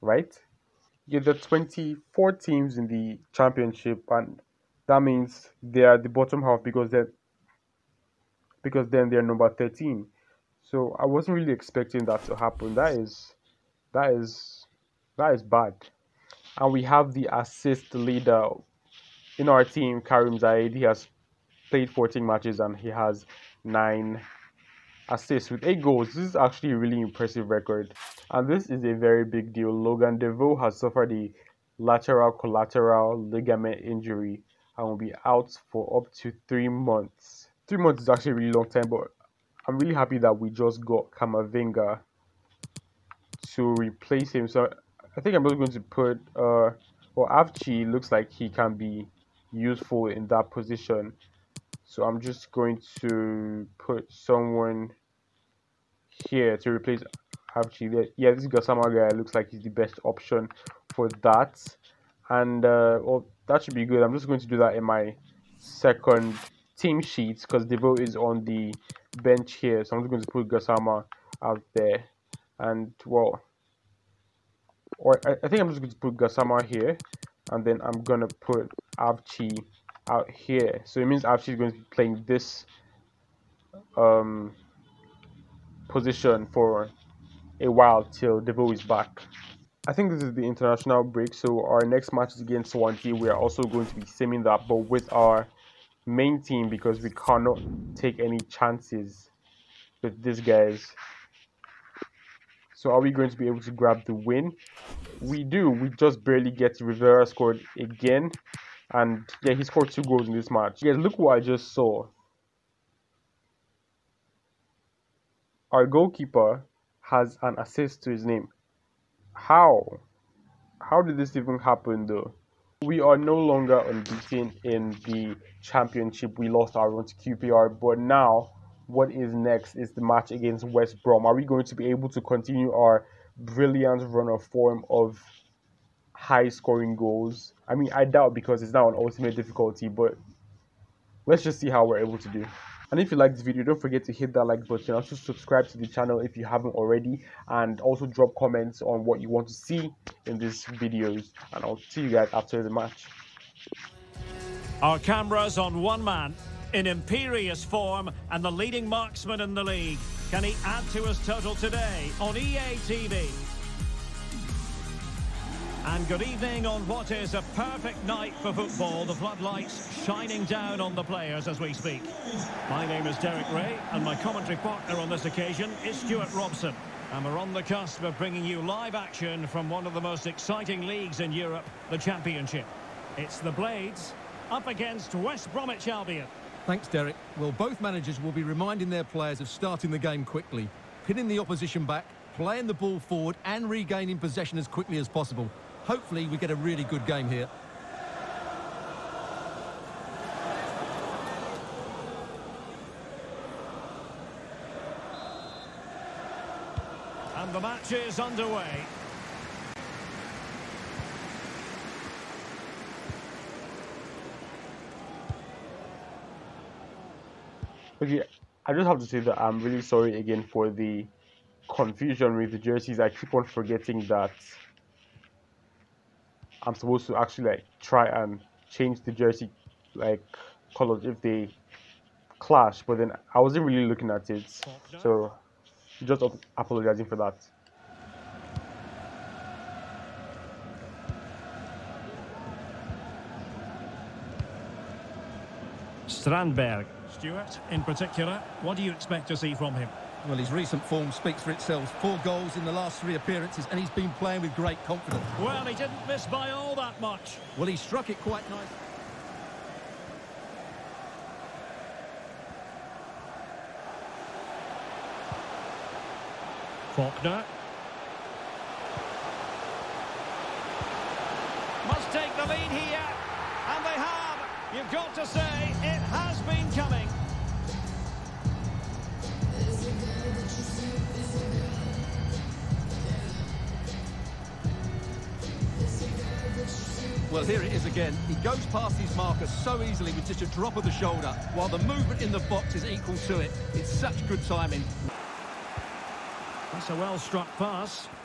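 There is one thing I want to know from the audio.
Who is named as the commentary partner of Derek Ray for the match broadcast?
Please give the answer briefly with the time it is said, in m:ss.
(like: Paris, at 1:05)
Stuart Robson, at 2:55.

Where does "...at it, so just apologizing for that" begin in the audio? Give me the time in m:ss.
3:54.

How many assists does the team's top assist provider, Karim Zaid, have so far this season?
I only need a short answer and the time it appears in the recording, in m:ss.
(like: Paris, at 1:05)
9, at 0:23.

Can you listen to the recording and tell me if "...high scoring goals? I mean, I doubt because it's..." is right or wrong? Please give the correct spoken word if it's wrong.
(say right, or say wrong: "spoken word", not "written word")
right.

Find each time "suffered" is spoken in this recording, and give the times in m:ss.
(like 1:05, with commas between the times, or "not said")
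0:30.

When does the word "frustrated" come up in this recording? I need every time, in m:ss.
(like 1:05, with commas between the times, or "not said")
not said.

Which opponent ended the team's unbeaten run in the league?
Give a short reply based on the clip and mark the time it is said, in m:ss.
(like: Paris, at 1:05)
QPR, at 2:07.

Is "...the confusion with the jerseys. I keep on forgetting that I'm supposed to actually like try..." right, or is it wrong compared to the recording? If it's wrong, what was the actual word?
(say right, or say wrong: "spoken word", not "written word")
right.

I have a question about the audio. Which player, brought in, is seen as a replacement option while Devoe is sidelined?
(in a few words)
Kamavinga.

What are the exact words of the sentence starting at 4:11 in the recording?
Four goals in the last three appearances, and he's been playing with great confidence.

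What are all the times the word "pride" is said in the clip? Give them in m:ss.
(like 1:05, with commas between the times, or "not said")
not said.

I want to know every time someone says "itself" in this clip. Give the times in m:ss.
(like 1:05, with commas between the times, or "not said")
4:11.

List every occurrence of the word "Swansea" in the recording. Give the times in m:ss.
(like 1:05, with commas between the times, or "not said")
1:32.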